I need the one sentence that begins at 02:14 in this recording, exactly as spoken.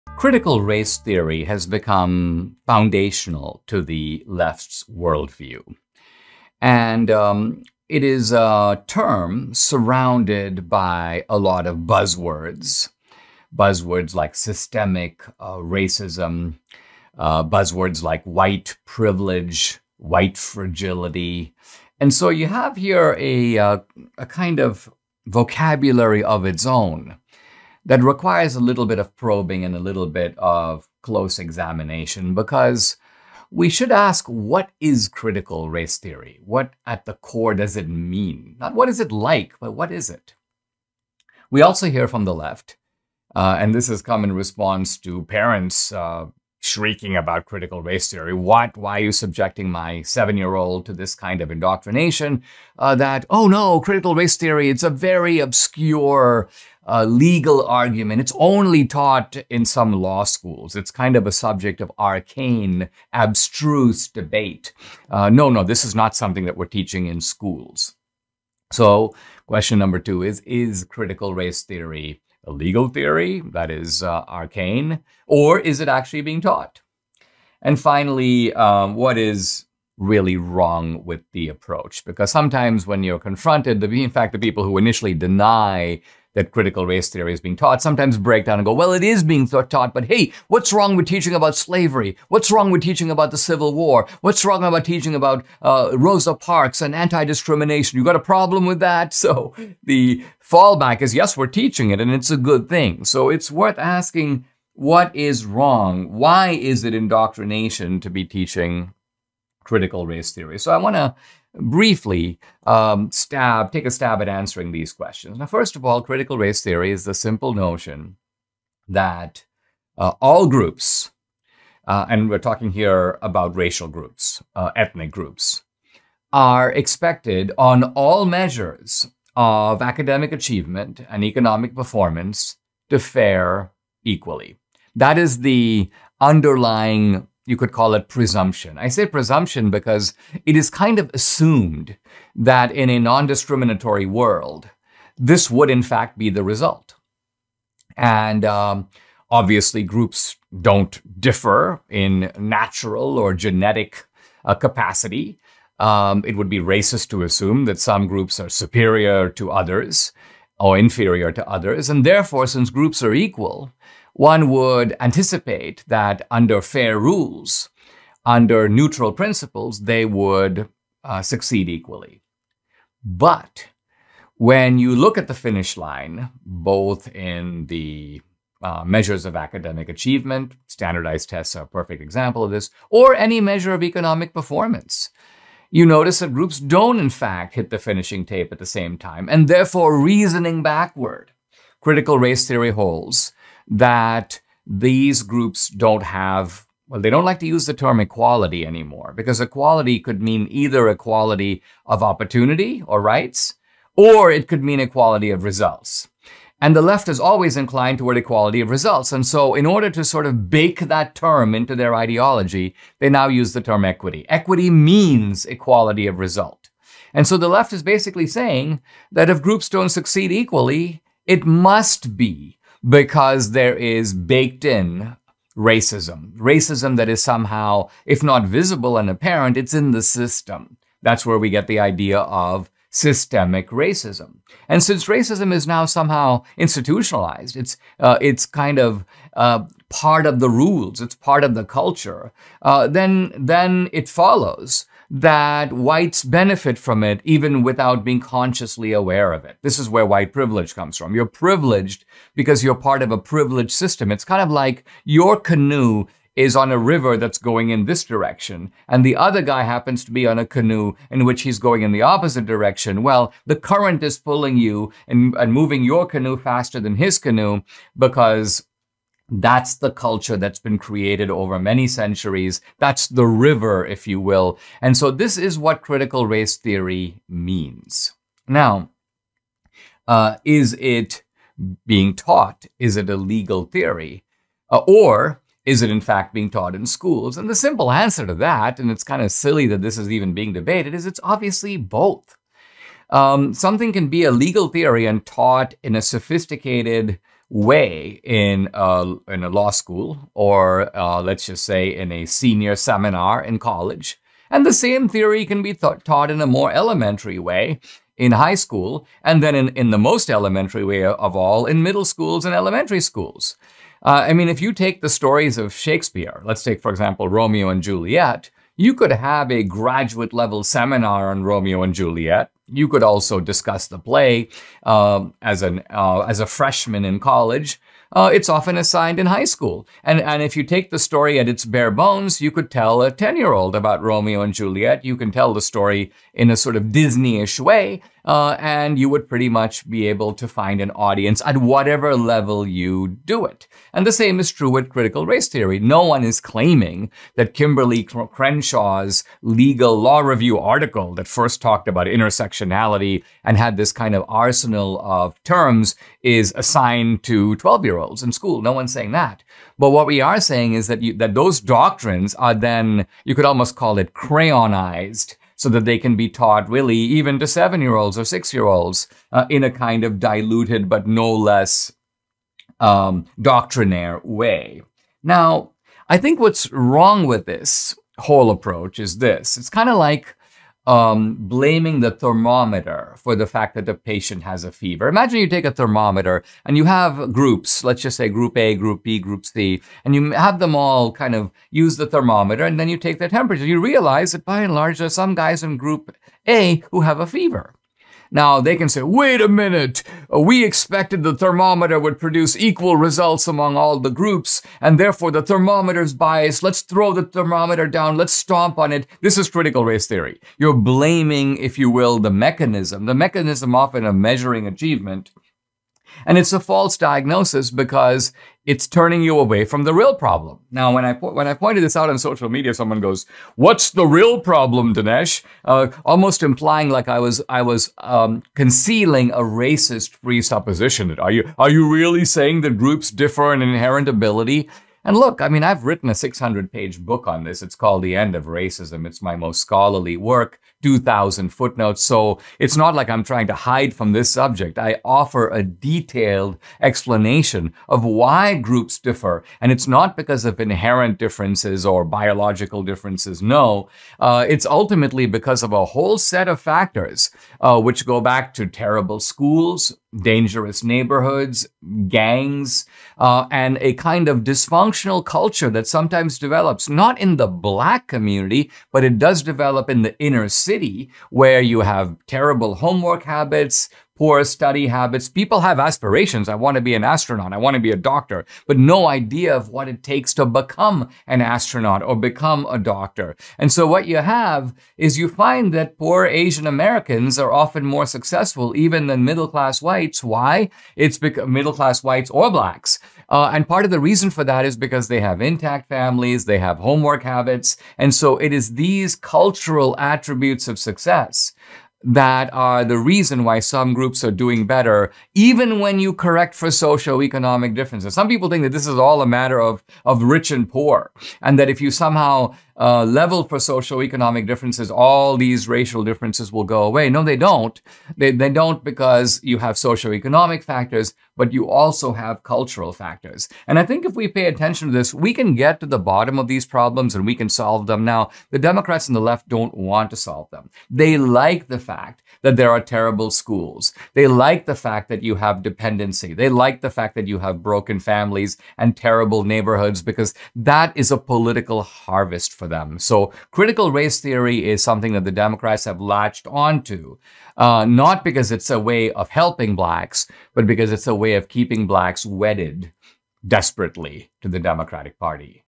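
That is the underlying you could call it presumption.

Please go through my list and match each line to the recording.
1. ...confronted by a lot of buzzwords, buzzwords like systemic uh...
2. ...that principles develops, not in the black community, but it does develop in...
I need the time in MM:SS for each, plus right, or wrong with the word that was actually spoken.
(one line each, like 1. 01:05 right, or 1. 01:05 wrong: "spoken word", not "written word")
1. 00:09 wrong: "surrounded", not "confronted"
2. 07:45 wrong: "sometimes", not "principles".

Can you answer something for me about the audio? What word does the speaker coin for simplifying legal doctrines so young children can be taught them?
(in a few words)
Crayonized.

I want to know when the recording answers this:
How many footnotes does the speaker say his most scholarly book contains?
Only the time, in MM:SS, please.
07:20.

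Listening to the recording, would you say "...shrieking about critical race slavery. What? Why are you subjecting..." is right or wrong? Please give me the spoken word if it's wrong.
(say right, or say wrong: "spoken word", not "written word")
wrong: "theory", not "slavery".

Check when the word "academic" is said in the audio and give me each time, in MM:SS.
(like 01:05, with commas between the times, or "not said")
02:09, 02:59.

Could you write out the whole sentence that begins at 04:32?
That's the river, if you will.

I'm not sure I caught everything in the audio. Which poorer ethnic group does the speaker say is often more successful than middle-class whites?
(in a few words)
Asian Americans.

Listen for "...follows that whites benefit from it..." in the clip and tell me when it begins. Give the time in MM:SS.
04:04.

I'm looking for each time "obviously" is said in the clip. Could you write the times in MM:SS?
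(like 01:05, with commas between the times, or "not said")
02:29, 04:51.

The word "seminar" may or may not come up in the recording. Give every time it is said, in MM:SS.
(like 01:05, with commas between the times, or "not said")
05:02, 05:20.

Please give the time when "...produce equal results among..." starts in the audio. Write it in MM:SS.
06:42.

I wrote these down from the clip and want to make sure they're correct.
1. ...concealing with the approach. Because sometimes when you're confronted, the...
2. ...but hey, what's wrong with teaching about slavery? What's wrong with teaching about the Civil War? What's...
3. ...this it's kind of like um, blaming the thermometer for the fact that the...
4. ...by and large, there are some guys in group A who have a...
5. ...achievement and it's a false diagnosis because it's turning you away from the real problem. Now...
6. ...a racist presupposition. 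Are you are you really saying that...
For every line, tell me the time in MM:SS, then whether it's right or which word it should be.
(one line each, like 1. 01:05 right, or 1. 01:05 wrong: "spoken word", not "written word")
1. 01:20 wrong: "wrong", not "concealing"
2. 01:29 right
3. 06:19 right
4. 06:34 right
5. 06:54 right
6. 07:09 right.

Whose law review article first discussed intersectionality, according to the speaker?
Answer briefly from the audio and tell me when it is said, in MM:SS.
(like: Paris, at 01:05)
Kimberly Crenshaw, at 05:47.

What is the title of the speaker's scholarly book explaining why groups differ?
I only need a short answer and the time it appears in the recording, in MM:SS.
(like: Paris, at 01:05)
The End of Racism, at 07:18.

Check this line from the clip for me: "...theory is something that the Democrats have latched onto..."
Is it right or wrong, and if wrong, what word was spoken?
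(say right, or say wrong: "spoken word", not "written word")
right.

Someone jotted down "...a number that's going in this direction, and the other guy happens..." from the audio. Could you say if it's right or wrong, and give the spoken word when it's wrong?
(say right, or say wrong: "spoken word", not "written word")
wrong: "river", not "number".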